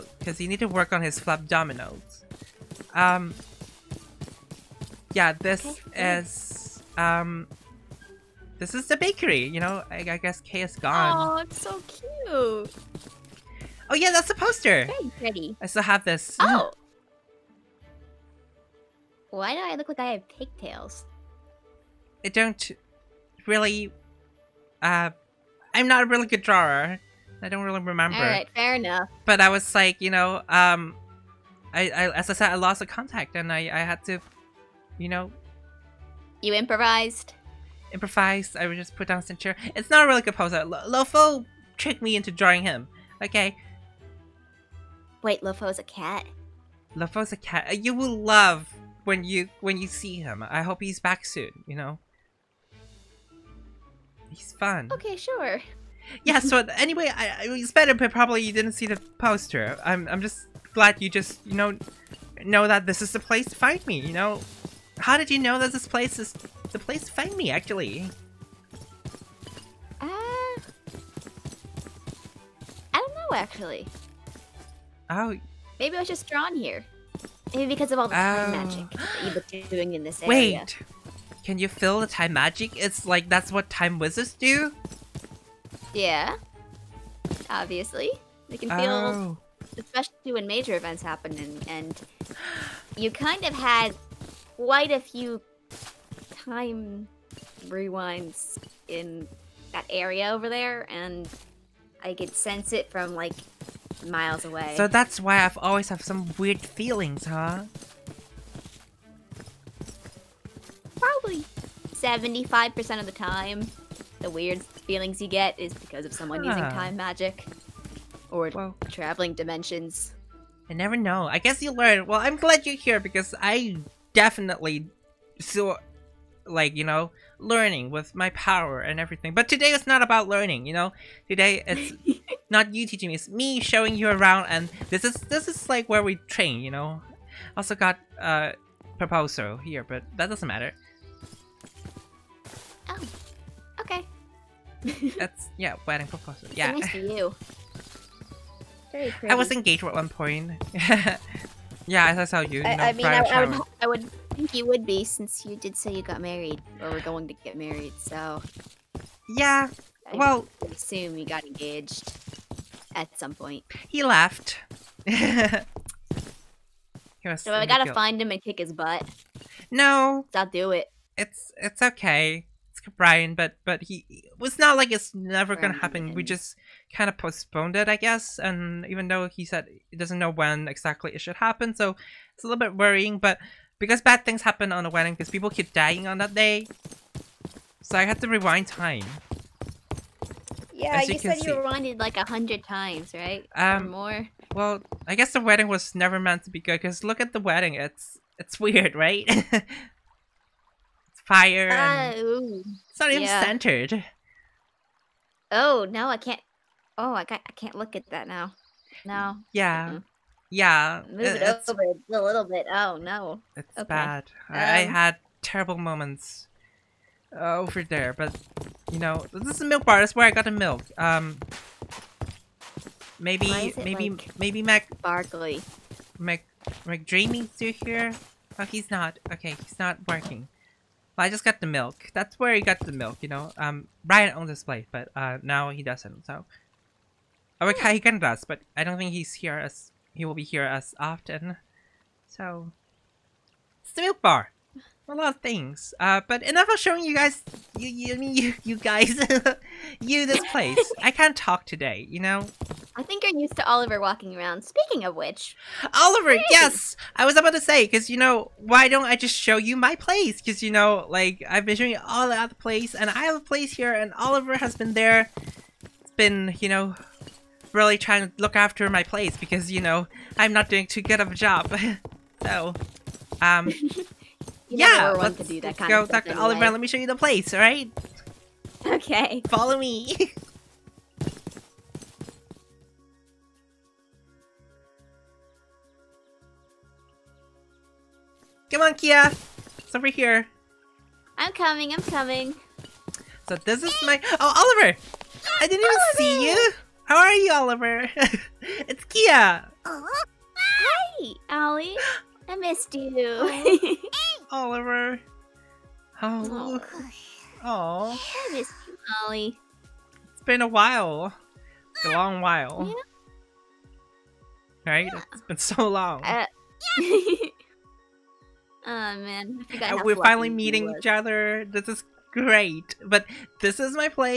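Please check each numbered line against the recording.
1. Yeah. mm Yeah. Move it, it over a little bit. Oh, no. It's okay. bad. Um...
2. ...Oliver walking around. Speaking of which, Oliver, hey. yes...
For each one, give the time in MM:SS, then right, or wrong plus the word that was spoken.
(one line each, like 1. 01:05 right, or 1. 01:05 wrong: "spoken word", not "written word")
1. 03:29 right
2. 04:13 right.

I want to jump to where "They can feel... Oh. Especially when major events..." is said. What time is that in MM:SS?
01:28.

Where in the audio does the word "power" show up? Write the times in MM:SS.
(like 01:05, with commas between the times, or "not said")
02:08.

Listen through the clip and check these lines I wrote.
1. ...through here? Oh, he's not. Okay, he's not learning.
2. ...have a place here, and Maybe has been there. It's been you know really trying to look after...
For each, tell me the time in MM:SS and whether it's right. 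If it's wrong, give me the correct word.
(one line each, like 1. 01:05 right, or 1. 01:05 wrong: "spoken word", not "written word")
1. 03:47 wrong: "working", not "learning"
2. 04:23 wrong: "Oliver", not "Maybe".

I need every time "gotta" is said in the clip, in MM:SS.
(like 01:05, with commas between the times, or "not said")
02:47.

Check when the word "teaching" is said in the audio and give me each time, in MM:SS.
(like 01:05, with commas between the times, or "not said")
02:12.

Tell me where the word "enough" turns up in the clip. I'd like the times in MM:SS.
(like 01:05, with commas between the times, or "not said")
00:28, 04:06.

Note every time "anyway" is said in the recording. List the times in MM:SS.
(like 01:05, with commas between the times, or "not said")
00:56, 04:36.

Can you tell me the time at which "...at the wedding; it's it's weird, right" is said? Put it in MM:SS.
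03:17.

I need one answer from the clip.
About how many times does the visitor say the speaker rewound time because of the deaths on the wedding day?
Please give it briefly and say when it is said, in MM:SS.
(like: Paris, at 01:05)
100, at 03:12.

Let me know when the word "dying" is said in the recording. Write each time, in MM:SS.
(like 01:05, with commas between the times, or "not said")
03:05.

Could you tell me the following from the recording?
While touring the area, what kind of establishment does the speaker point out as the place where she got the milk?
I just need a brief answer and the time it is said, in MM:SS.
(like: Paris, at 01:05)
milk bar, at 03:39.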